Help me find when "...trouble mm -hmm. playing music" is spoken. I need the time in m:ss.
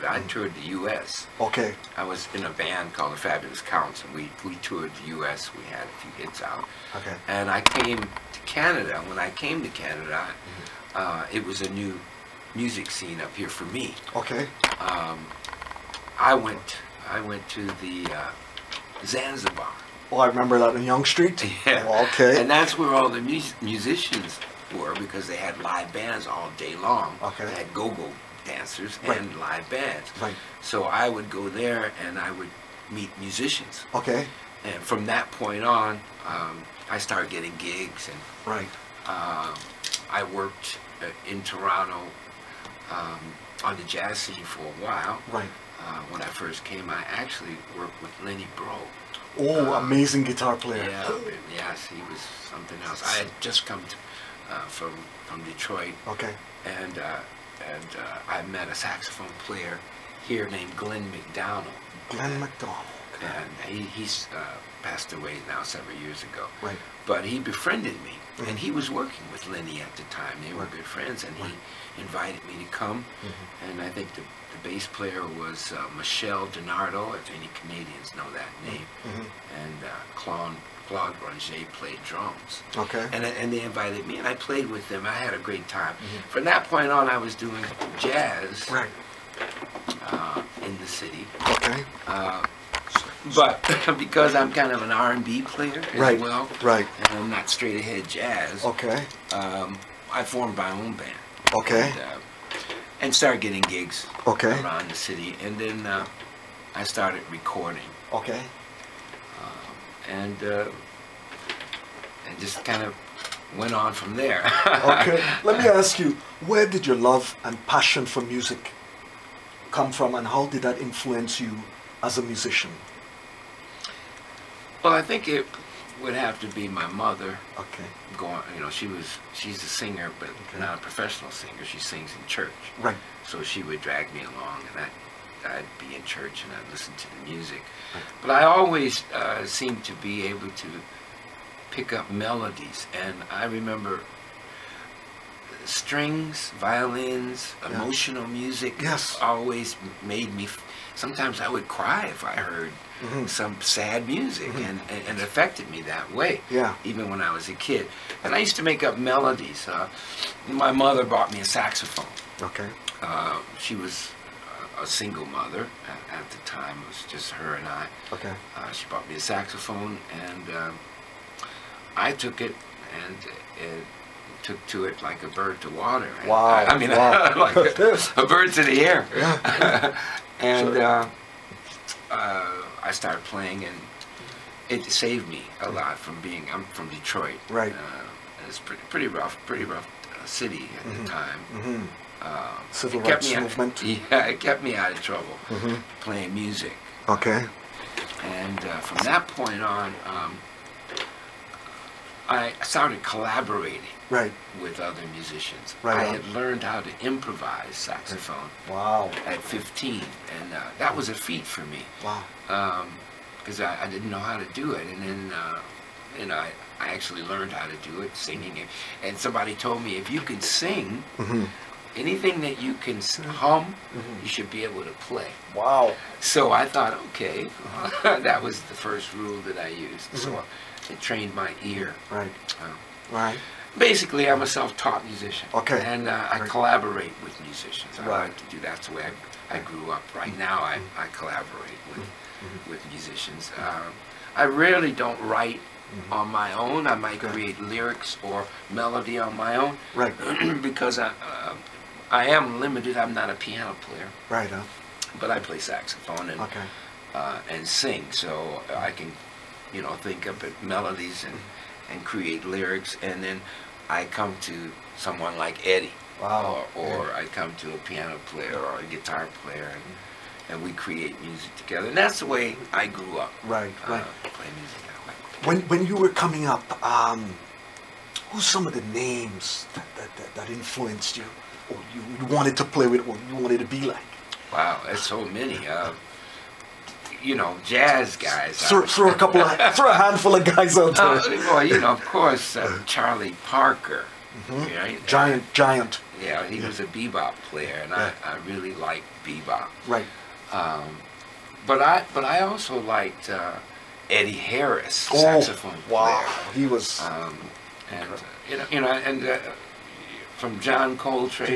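3:15.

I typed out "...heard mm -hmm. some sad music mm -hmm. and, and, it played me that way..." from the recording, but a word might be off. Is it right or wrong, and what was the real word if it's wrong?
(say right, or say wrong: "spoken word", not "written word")
wrong: "affected", not "played".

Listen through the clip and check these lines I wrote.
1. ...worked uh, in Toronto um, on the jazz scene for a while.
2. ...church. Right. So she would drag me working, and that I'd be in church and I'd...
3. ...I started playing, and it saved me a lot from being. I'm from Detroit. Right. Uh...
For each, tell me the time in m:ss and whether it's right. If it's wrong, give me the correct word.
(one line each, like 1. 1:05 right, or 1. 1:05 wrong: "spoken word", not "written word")
1. 0:40 right
2. 2:12 wrong: "along", not "working"
3. 3:02 right.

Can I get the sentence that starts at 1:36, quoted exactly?
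well, right, and I'm not straight ahead jazz.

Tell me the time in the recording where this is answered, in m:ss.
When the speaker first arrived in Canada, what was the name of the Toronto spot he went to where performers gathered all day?
0:19.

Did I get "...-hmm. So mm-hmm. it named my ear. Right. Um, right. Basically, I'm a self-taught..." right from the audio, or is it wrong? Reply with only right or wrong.
wrong.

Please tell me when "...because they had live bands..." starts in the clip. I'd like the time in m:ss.
0:24.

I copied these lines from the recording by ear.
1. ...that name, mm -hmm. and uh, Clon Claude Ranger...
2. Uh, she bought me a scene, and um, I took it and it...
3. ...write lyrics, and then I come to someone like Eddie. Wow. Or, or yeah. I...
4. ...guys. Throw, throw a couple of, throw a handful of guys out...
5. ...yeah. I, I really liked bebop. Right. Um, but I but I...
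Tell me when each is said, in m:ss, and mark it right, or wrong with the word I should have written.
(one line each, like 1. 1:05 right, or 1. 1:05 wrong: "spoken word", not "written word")
1. 1:18 right
2. 2:48 wrong: "saxophone", not "scene"
3. 4:22 wrong: "create", not "write"
4. 4:48 right
5. 4:57 right.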